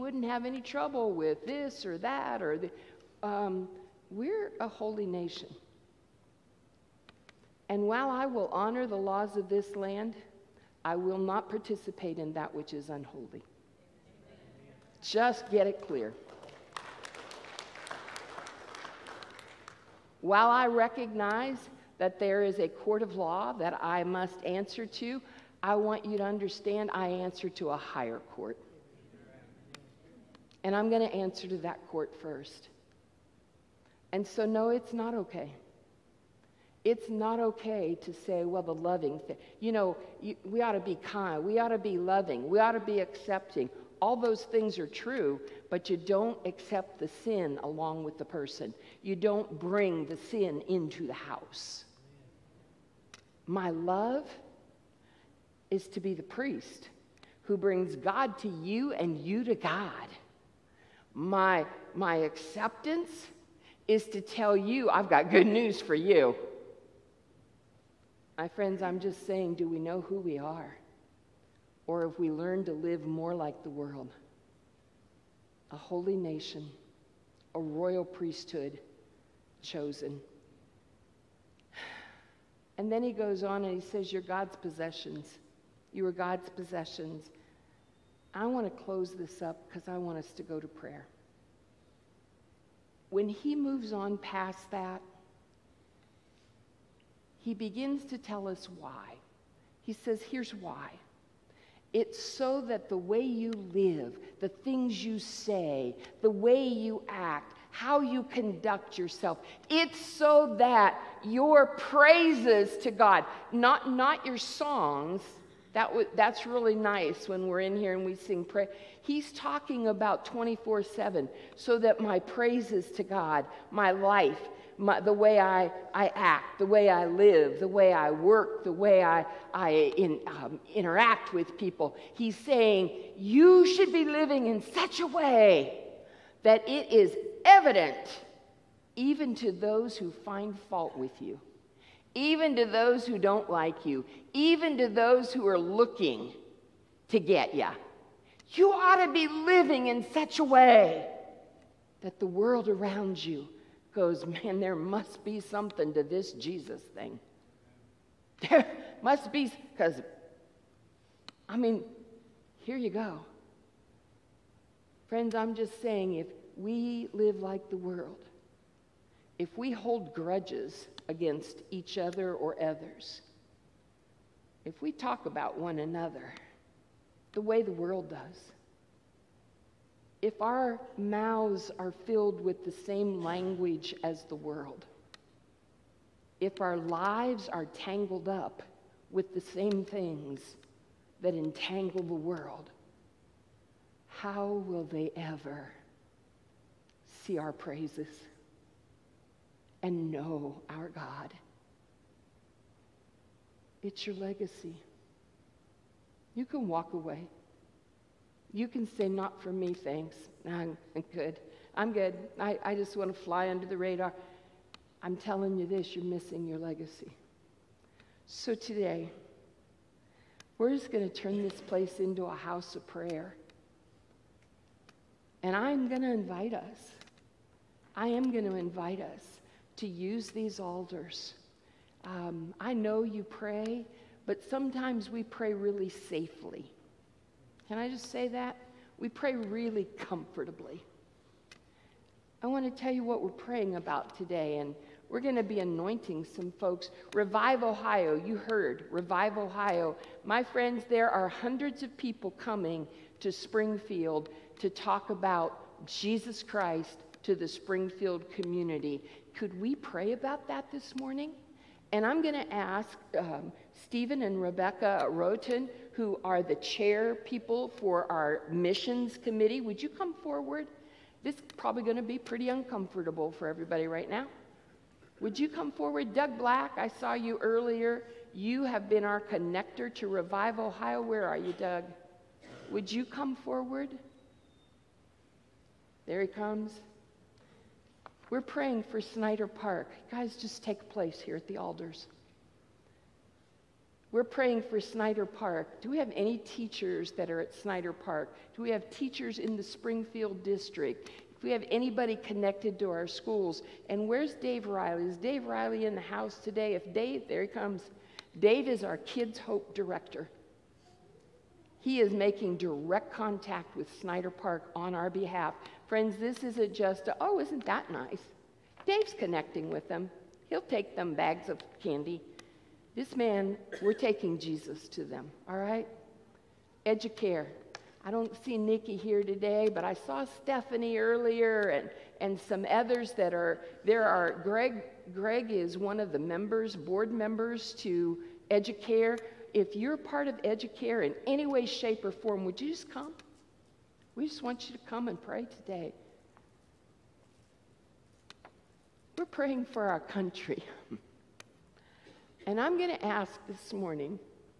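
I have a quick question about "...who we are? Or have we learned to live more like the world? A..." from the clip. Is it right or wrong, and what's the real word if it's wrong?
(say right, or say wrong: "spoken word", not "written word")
right.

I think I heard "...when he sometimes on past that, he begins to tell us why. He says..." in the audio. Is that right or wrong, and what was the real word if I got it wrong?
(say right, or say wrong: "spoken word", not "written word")
wrong: "moves", not "sometimes".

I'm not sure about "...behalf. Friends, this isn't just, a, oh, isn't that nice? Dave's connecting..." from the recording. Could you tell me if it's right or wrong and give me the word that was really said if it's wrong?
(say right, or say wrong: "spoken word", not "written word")
right.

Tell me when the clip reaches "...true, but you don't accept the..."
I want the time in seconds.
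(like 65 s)
44 s.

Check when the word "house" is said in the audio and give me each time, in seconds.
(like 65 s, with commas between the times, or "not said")
51 s, 222 s, 306 s.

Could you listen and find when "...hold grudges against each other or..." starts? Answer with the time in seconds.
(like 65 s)
169 s.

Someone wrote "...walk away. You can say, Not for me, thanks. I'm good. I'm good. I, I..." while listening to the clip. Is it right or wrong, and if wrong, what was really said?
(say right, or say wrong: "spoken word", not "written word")
right.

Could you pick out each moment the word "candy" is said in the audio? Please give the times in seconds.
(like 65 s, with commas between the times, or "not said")
321 s.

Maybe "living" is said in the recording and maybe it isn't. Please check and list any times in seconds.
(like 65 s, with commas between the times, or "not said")
134 s, 149 s.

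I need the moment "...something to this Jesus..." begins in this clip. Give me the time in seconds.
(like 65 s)
155 s.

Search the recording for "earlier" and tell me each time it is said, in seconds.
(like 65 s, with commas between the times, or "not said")
277 s, 330 s.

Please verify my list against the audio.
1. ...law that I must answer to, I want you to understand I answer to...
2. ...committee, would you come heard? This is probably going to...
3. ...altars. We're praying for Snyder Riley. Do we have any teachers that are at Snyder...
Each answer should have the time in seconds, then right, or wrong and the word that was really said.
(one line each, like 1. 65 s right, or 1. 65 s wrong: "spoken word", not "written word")
1. 23 s right
2. 269 s wrong: "forward", not "heard"
3. 291 s wrong: "Park", not "Riley".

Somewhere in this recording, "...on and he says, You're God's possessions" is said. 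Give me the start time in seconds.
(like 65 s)
83 s.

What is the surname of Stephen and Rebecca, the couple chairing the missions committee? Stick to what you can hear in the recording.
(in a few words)
Roten.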